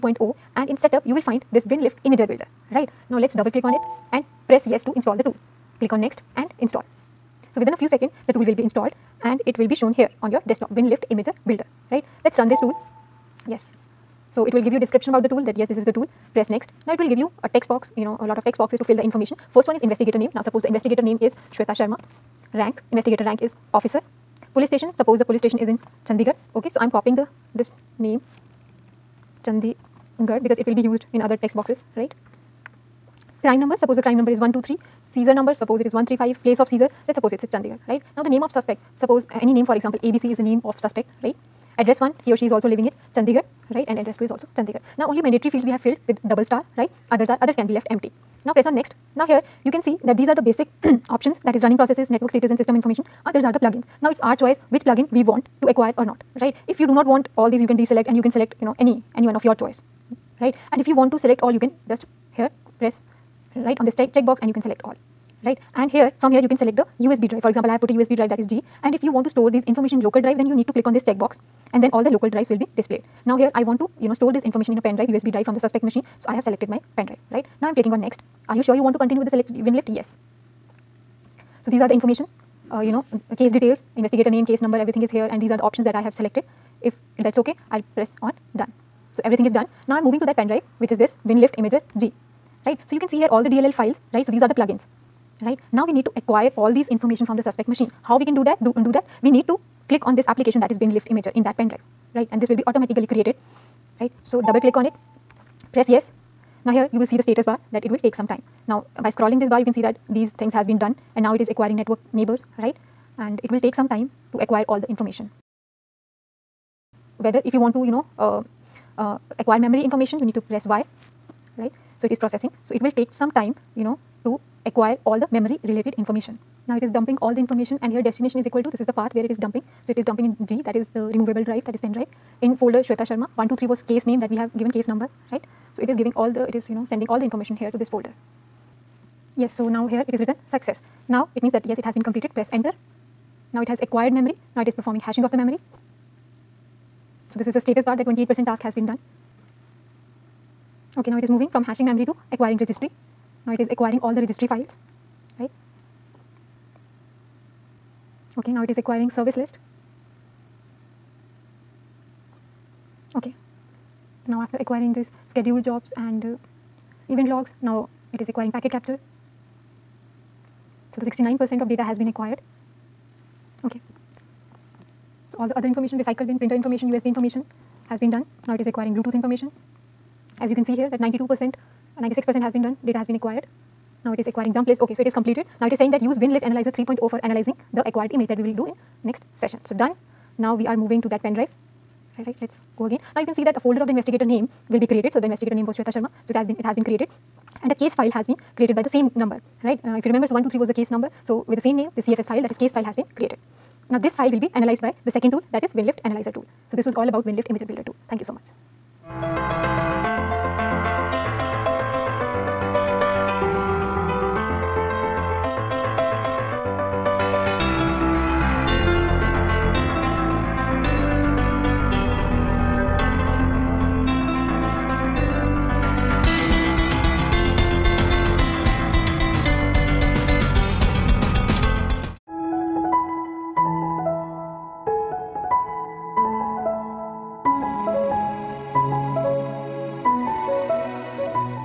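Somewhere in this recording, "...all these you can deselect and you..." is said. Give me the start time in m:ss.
0:57.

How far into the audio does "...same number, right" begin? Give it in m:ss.
3:18.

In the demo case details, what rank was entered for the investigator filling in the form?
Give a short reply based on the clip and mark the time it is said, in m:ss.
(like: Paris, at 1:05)
Officer, at 0:23.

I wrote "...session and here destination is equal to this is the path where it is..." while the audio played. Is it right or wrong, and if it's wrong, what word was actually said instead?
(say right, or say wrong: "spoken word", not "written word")
wrong: "information", not "session".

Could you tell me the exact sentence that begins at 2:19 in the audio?
Yes so now here it is written success.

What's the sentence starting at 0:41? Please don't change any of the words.
Address 1, he or she is also living in Chandigarh, right and address 2 is also Chandigarh.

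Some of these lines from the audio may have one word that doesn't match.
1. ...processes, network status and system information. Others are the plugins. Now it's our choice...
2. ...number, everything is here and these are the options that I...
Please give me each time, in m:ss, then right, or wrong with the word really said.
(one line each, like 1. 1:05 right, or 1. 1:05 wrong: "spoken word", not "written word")
1. 0:51 right
2. 1:24 right.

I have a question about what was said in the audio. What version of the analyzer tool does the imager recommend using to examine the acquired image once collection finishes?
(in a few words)
3.0.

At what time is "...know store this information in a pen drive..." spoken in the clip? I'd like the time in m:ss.
1:14.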